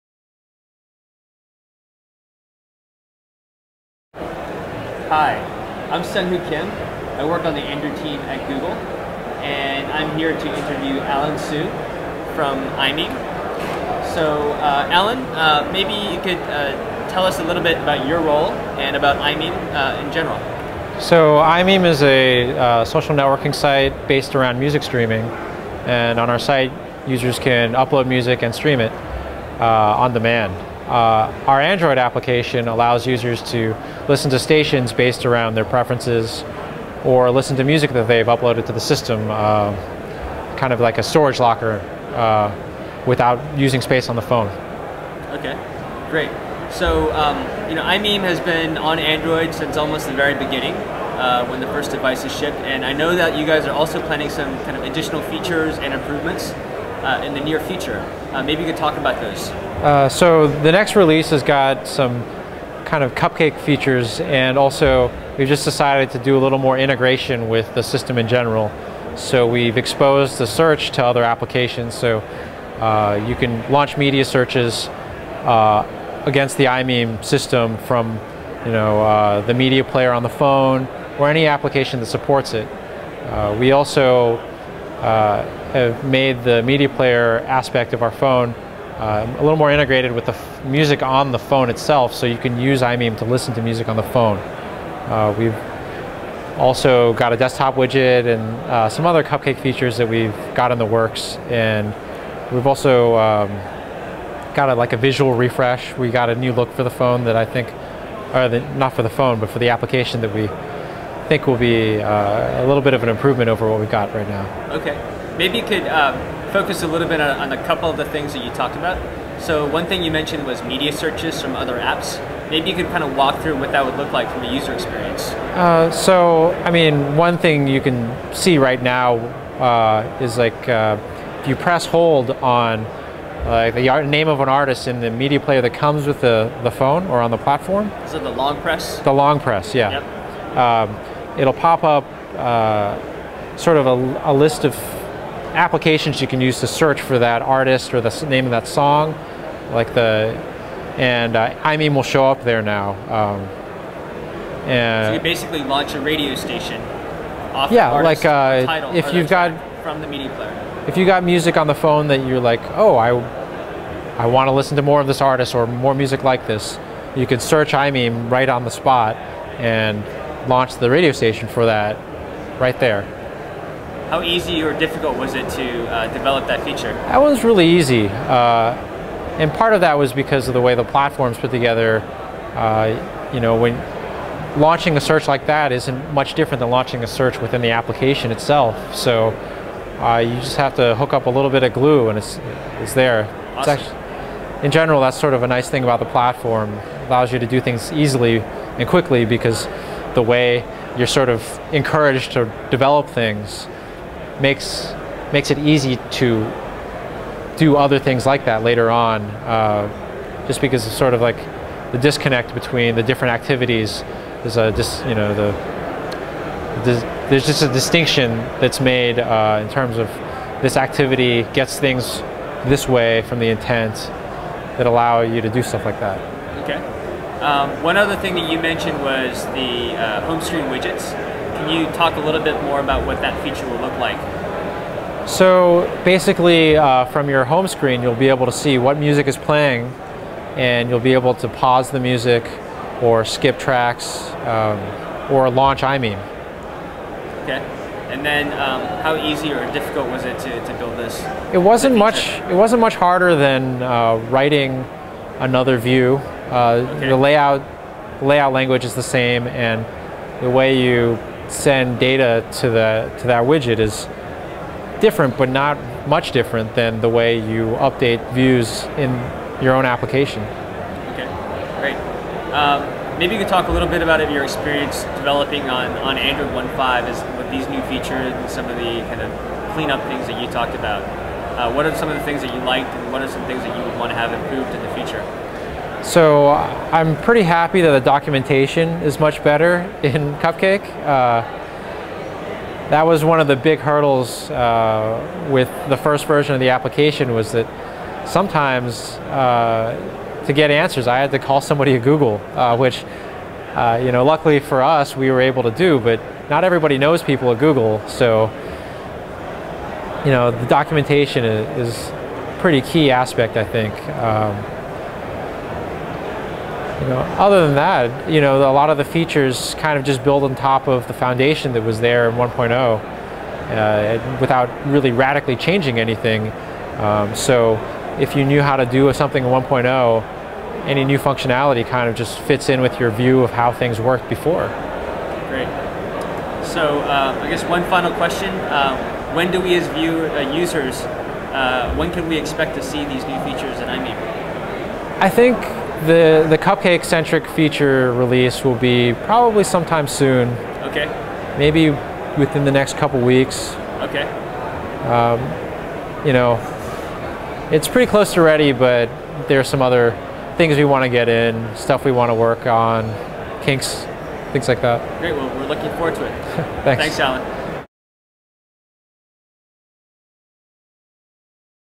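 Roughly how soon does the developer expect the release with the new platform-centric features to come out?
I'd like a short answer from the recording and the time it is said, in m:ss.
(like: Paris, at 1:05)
next couple weeks, at 5:52.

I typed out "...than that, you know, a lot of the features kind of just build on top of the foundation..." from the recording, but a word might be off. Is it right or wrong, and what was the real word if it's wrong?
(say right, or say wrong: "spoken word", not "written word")
right.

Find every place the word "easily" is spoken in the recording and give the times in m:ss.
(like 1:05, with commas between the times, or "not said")
3:17.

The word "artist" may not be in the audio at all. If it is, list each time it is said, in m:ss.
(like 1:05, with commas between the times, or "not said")
2:14, 2:27, 2:45.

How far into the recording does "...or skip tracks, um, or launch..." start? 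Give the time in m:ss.
4:03.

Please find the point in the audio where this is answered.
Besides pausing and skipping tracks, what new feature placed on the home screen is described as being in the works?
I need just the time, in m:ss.
1:37.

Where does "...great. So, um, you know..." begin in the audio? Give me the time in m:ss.
0:46.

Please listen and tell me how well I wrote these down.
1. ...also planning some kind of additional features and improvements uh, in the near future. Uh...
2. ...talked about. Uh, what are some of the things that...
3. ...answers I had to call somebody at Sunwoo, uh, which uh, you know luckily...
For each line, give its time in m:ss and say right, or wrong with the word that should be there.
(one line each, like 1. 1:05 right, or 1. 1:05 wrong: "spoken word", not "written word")
1. 0:53 right
2. 4:40 right
3. 5:00 wrong: "Google", not "Sunwoo".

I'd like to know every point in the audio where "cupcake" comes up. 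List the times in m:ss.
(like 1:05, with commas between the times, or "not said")
1:03, 1:39, 4:50, 5:46.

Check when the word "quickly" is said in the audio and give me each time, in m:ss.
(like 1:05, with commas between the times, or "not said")
3:18.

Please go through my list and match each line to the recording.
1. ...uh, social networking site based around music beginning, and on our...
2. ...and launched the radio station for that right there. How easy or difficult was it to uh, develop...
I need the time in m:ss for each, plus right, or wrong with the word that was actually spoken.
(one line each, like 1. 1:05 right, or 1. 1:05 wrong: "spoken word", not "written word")
1. 0:22 wrong: "streaming", not "beginning"
2. 2:49 right.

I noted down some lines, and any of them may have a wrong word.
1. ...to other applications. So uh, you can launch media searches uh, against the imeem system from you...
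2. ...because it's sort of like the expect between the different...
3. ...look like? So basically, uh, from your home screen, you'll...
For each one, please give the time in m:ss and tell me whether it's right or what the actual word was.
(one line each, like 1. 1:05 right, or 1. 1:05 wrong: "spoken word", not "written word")
1. 1:10 right
2. 3:30 wrong: "disconnect", not "expect"
3. 3:53 right.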